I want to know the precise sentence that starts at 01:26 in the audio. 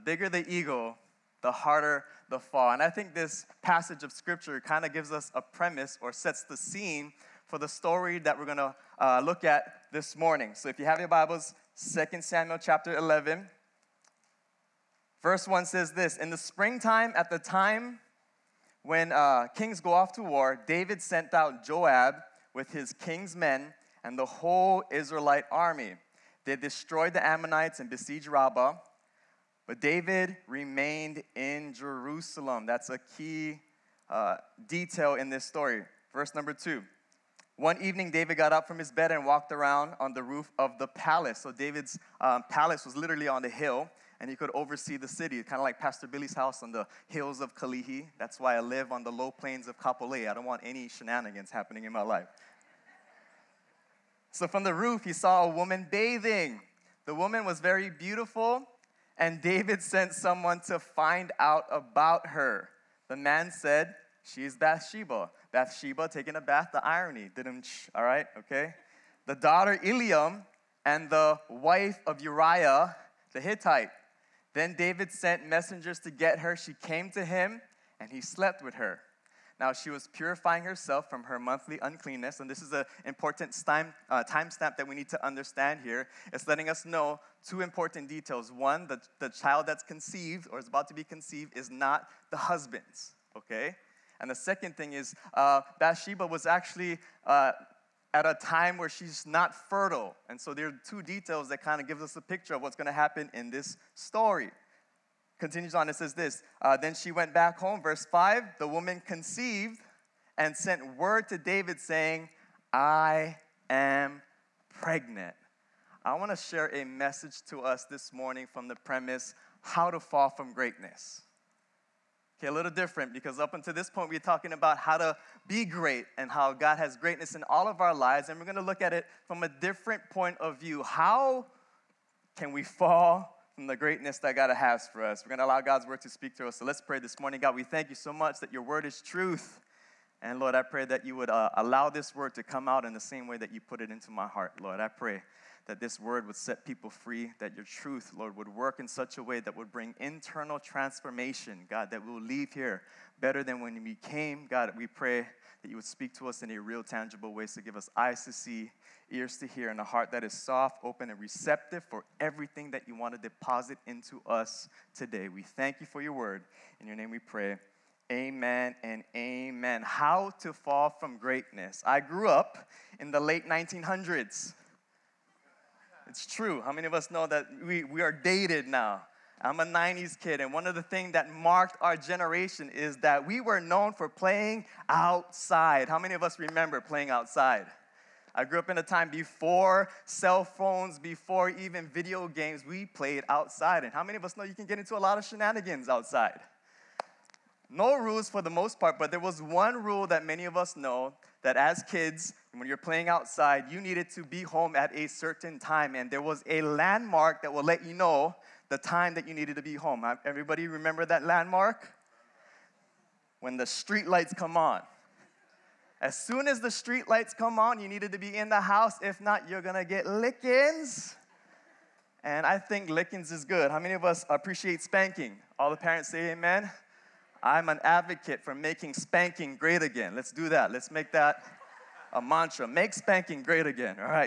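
It's letting us know two important details.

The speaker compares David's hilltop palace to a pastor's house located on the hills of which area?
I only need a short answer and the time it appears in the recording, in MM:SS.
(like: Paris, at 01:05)
Kalihi, at 00:47.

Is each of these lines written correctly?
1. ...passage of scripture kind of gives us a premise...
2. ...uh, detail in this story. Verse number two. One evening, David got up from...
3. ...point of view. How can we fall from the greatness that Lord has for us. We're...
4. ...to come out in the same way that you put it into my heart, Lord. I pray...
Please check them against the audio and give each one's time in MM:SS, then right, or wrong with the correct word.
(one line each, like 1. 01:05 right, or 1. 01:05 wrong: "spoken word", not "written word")
1. 00:03 right
2. 00:34 right
3. 02:10 wrong: "God", not "Lord"
4. 02:22 right.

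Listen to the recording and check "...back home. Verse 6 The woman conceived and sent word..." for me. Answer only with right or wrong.
wrong.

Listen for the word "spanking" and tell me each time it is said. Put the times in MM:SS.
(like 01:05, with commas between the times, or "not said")
03:44, 03:48, 03:52.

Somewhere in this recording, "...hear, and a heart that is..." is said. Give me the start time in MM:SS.
02:39.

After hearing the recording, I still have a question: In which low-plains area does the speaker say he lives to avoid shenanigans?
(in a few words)
Kapolei.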